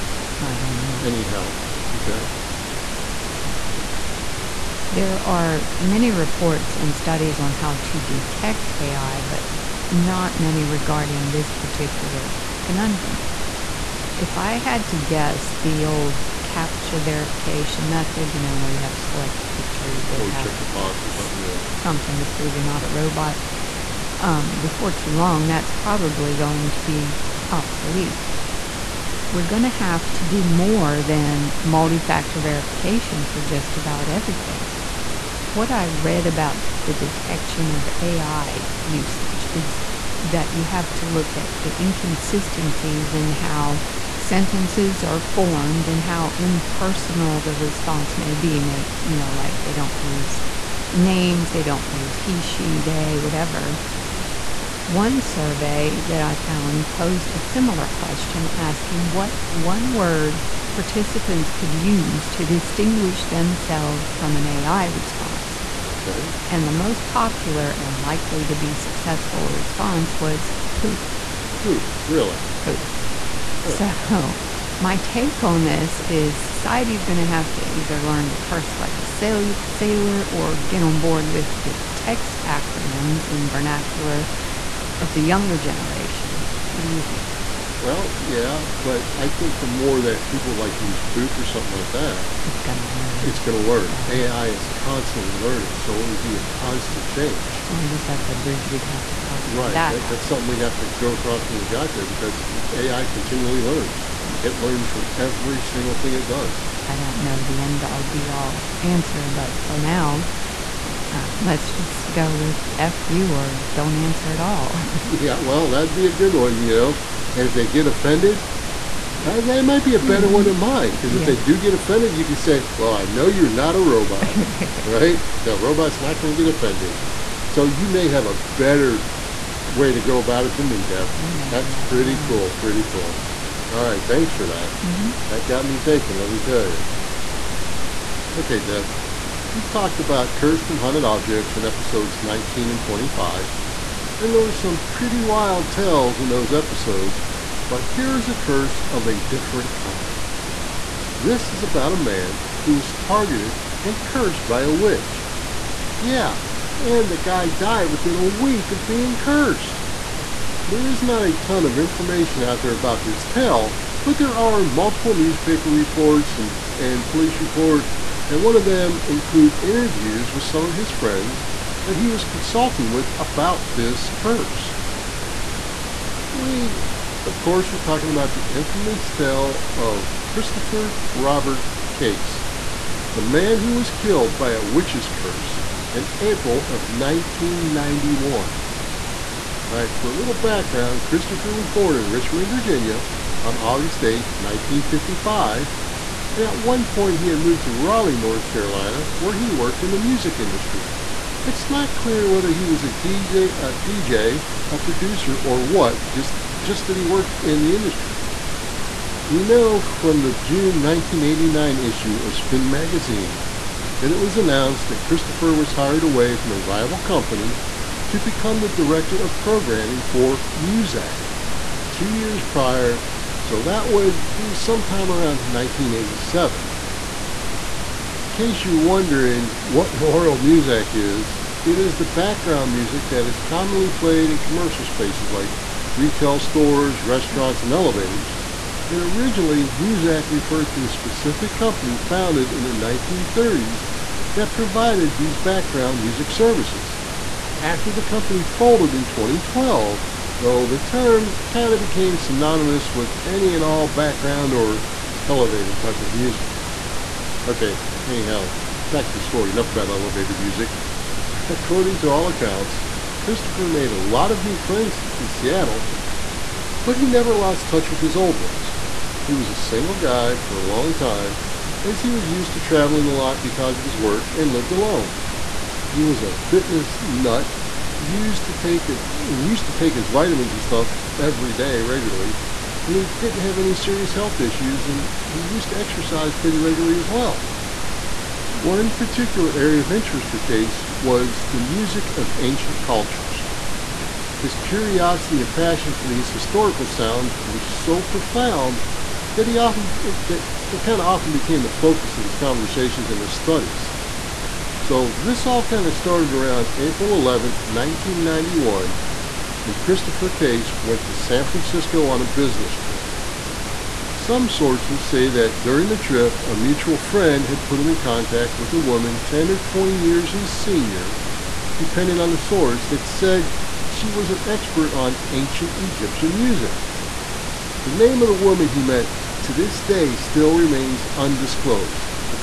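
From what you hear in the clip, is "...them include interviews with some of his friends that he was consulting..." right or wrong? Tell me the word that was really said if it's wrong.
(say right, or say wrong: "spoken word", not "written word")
right.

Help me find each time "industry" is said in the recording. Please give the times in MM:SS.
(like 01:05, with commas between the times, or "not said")
03:20, 03:27.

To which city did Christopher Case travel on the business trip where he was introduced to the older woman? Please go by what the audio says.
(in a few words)
San Francisco.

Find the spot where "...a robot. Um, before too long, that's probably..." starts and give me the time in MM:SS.
00:22.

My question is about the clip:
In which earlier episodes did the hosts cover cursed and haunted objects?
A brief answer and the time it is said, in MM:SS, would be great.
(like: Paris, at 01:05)
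19 and 25, at 02:22.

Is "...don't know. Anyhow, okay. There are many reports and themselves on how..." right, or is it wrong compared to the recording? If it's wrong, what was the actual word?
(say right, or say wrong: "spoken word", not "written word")
wrong: "studies", not "themselves".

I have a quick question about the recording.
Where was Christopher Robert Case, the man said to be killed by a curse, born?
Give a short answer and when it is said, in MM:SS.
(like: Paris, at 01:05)
Richmond, Virginia, at 03:12.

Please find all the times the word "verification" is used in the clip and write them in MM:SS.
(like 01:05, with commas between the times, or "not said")
00:17, 00:32.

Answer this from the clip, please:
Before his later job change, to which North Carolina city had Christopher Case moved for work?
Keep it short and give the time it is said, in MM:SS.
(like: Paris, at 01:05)
Raleigh, at 03:17.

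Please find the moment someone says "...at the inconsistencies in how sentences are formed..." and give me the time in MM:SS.
00:41.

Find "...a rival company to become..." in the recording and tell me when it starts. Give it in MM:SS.
03:36.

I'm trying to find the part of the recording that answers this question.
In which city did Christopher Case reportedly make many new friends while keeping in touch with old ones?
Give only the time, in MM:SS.
04:25.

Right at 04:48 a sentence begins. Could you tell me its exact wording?
One particular area of interest for Case was the music of ancient cultures.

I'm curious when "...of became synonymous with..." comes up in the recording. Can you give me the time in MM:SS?
04:11.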